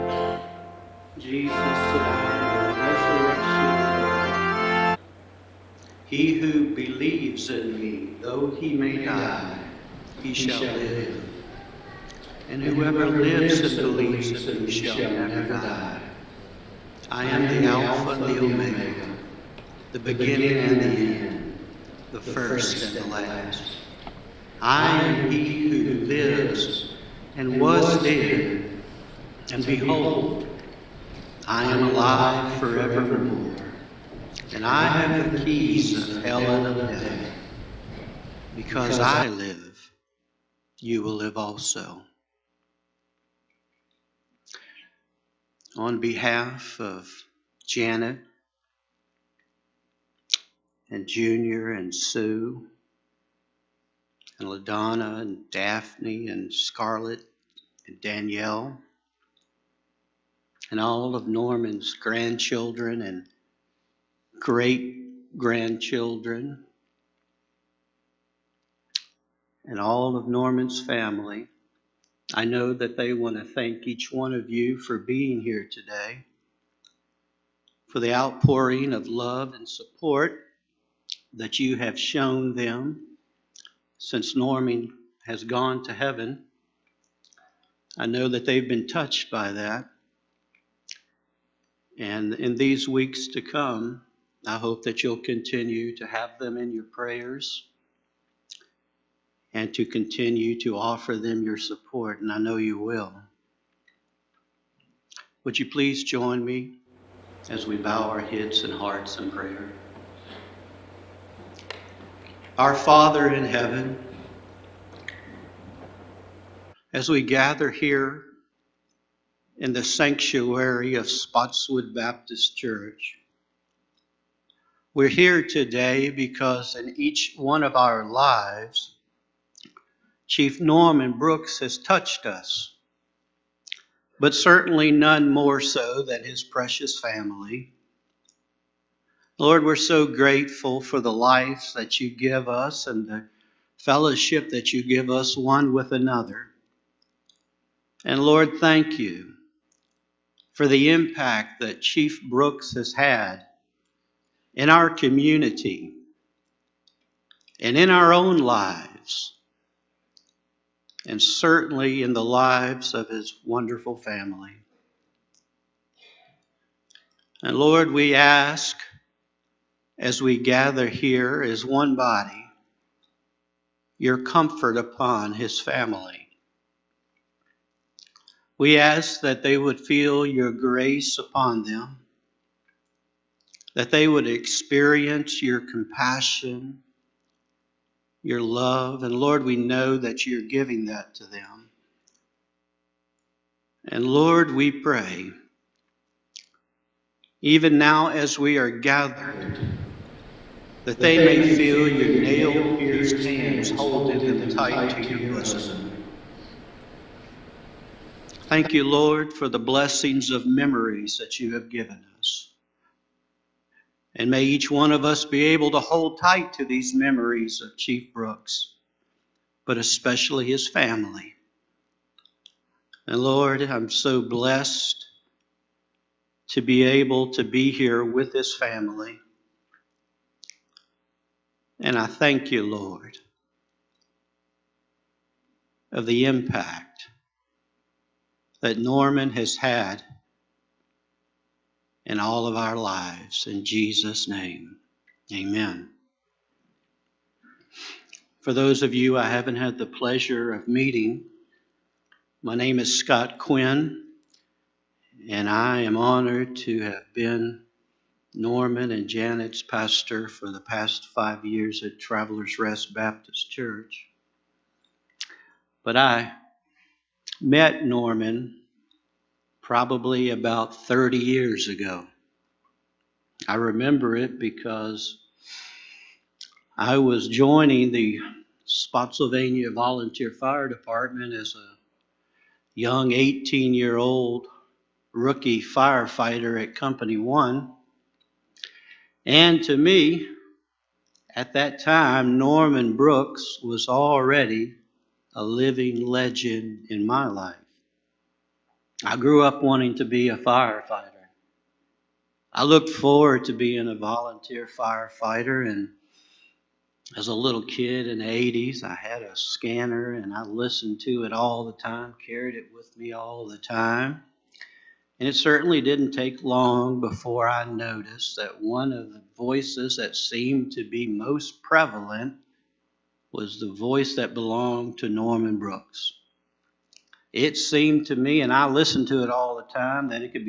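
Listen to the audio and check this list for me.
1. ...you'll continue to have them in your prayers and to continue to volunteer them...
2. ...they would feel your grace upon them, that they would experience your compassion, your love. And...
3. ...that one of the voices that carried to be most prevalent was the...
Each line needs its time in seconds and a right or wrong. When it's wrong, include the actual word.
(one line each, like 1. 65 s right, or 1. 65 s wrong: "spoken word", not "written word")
1. 95 s wrong: "offer", not "volunteer"
2. 179 s right
3. 318 s wrong: "seemed", not "carried".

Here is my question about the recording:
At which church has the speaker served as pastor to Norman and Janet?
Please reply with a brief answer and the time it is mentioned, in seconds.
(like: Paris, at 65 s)
Travelers Rest Baptist Church, at 261 s.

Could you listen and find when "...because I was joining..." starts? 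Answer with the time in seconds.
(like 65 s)
274 s.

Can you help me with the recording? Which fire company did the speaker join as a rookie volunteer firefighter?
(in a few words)
Company One.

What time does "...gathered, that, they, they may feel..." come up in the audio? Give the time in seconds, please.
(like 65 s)
198 s.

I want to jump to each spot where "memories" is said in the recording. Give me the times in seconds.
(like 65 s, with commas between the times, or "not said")
210 s, 216 s.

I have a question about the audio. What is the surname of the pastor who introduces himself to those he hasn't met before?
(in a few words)
Quinn.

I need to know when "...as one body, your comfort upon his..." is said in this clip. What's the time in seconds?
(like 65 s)
171 s.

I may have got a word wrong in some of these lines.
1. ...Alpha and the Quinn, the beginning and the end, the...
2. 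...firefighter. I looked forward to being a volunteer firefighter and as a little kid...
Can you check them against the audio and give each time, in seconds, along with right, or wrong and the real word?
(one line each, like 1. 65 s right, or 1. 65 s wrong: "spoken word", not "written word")
1. 17 s wrong: "Omega", not "Quinn"
2. 300 s right.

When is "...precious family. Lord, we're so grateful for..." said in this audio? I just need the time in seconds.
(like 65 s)
136 s.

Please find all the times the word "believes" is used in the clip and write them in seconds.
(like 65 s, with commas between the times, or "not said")
6 s, 13 s.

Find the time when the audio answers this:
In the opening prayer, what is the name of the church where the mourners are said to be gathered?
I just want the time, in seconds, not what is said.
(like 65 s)
121 s.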